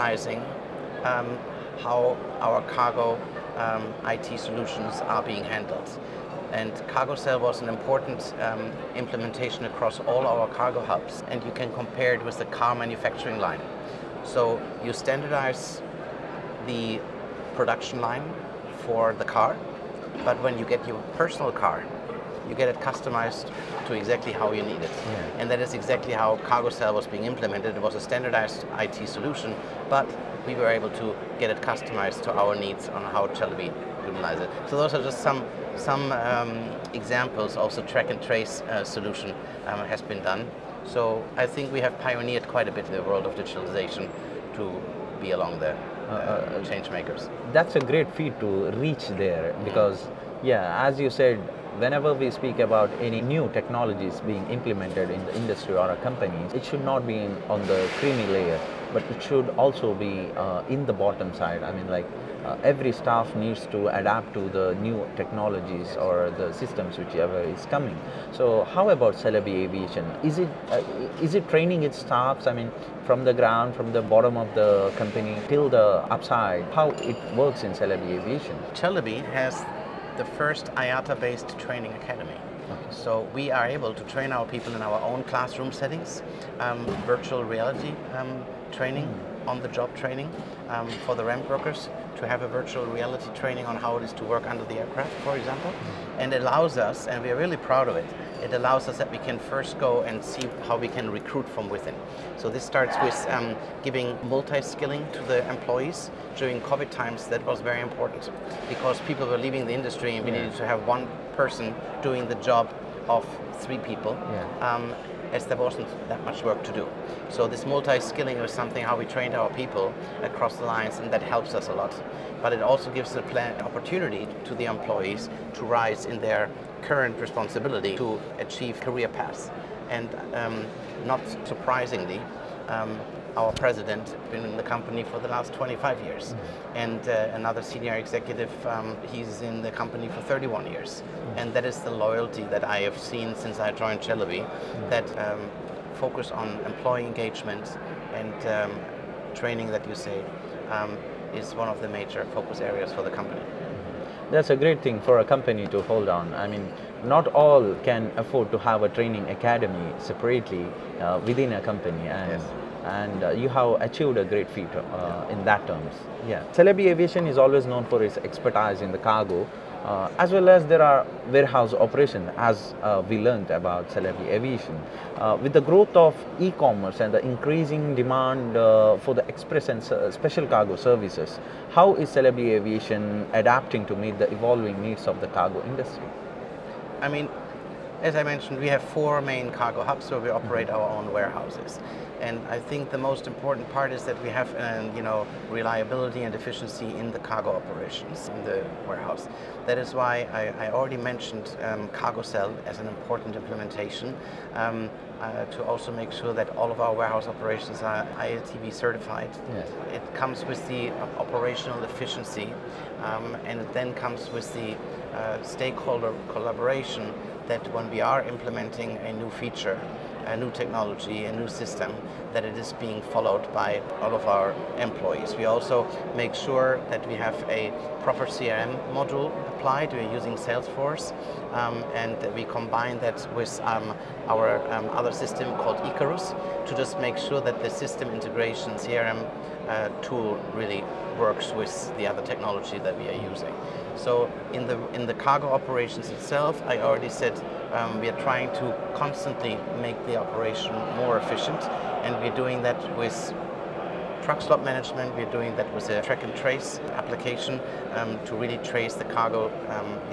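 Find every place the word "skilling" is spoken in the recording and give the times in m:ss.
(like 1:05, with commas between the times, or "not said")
1:44, 1:57.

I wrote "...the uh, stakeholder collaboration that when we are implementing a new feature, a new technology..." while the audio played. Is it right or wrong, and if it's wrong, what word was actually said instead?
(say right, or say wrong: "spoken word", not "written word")
right.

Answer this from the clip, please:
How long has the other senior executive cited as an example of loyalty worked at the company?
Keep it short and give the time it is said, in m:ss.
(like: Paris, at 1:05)
31 years, at 2:20.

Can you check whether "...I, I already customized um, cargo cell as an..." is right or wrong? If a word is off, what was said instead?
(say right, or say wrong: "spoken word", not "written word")
wrong: "mentioned", not "customized".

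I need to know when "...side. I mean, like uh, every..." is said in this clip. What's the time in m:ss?
1:01.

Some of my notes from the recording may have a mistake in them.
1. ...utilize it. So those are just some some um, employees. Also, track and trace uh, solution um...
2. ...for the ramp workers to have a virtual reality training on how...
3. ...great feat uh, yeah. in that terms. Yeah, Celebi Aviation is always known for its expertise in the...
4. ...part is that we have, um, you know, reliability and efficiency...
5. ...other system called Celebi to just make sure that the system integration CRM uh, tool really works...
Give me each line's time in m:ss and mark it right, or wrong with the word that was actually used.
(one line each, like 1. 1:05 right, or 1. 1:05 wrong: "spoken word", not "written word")
1. 0:34 wrong: "examples", not "employees"
2. 1:31 right
3. 2:44 right
4. 3:13 right
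5. 3:54 wrong: "Icarus", not "Celebi".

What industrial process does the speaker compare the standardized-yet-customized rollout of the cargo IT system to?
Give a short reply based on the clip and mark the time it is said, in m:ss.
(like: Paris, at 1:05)
car manufacturing line, at 0:12.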